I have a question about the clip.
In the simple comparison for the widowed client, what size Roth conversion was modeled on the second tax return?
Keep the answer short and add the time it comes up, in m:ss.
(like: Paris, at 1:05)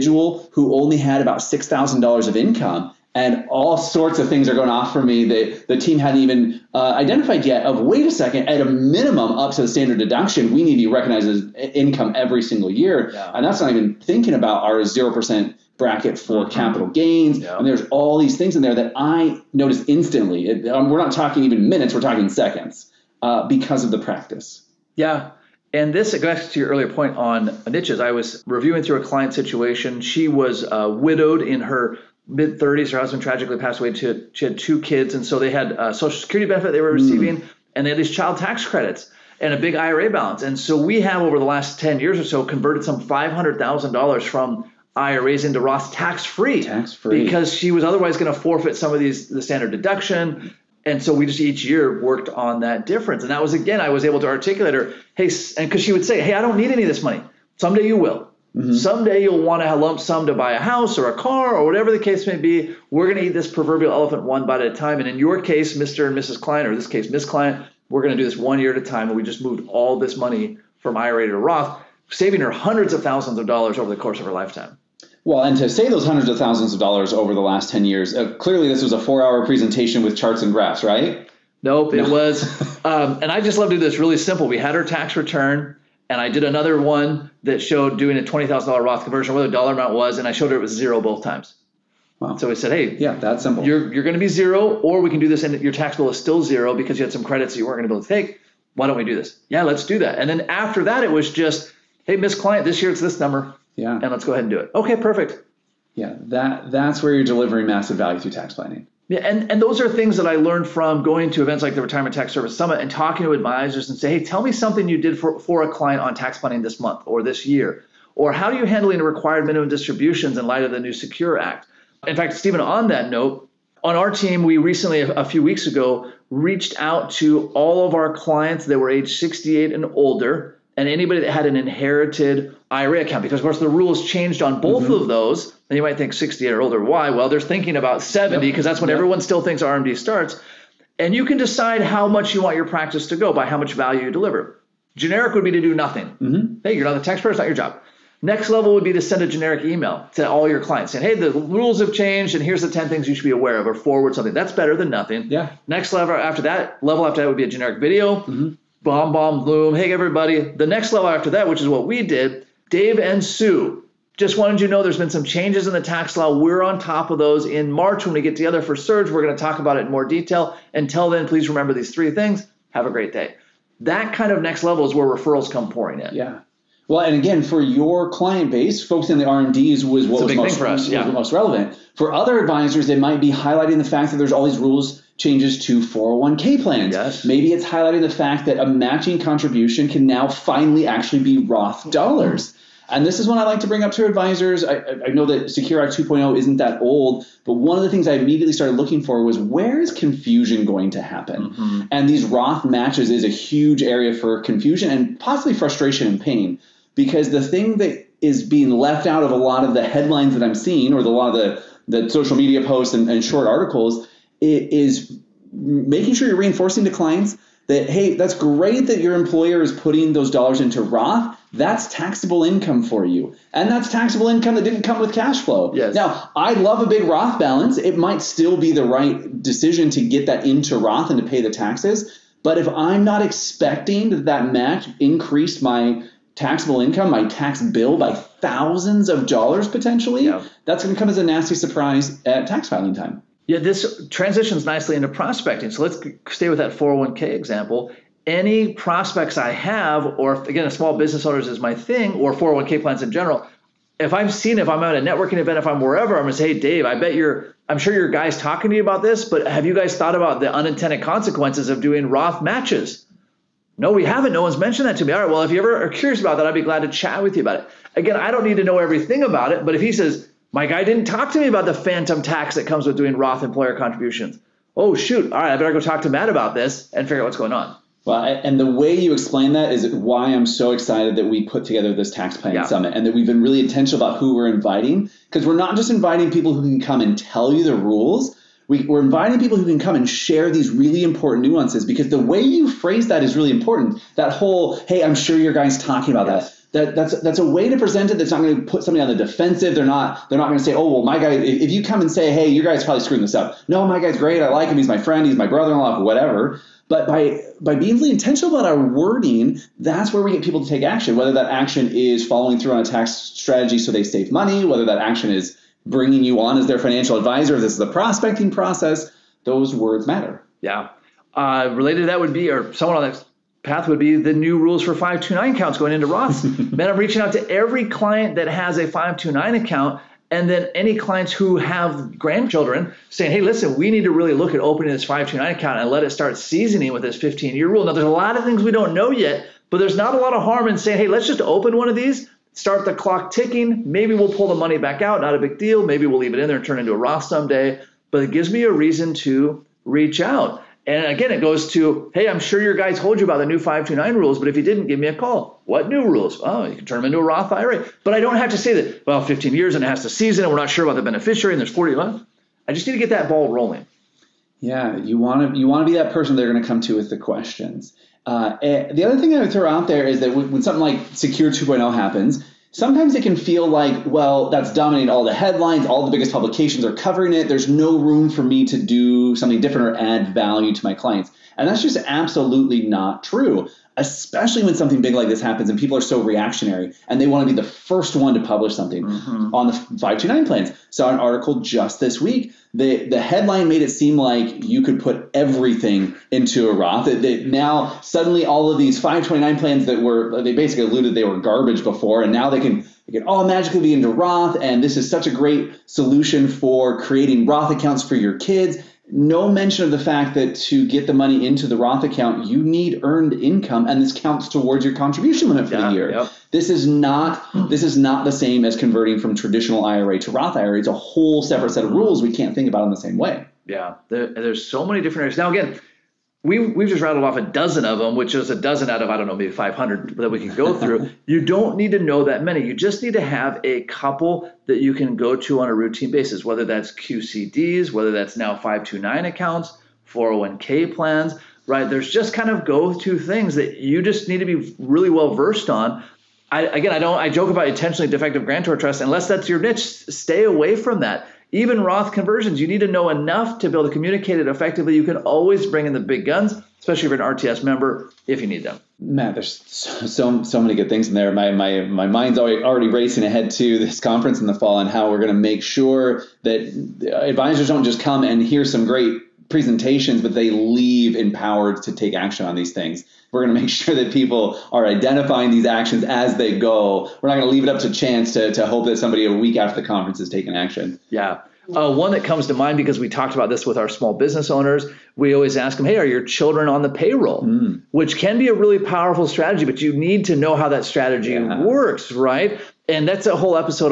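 $20,000, at 1:28.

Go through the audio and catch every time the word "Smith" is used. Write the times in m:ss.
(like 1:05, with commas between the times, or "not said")
not said.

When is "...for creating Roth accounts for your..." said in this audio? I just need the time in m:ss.
6:46.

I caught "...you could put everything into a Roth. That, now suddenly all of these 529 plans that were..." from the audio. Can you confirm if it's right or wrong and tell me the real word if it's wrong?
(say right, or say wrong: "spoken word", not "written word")
right.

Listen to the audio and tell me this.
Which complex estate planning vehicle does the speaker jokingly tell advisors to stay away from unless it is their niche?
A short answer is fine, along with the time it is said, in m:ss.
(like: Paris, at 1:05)
intentionally defective grantor trust, at 7:27.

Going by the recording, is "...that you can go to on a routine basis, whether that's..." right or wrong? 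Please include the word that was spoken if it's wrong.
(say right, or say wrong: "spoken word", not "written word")
right.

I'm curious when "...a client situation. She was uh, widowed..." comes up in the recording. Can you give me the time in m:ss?
0:29.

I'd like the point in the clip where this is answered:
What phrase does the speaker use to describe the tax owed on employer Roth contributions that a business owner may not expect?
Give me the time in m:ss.
4:31.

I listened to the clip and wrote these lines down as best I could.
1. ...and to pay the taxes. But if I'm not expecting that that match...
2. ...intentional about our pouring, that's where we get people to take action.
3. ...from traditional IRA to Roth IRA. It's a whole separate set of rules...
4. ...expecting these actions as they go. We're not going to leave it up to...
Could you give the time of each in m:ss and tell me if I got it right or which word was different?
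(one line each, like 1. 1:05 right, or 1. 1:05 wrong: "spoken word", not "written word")
1. 3:51 right
2. 5:08 wrong: "wording", not "pouring"
3. 6:59 right
4. 7:54 wrong: "identifying", not "expecting".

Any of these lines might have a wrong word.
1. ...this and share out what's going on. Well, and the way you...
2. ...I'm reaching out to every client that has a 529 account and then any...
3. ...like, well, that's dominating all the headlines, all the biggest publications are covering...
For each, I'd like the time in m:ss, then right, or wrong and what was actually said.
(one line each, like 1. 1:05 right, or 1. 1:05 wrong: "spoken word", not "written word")
1. 4:36 wrong: "figure", not "share"
2. 5:26 right
3. 6:13 right.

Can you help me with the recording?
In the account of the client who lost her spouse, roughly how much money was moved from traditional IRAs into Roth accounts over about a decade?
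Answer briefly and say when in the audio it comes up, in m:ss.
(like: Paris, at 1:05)
$500,000, at 0:43.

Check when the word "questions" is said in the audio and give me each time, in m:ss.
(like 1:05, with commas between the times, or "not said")
6:07.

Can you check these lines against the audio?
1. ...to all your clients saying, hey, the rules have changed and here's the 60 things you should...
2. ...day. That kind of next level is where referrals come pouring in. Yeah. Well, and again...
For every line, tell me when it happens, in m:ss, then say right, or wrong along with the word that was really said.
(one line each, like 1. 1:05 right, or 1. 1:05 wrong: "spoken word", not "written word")
1. 2:30 wrong: "10", not "60"
2. 2:53 right.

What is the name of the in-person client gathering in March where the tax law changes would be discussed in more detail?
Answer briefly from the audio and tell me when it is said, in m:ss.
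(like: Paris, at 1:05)
Surge, at 2:48.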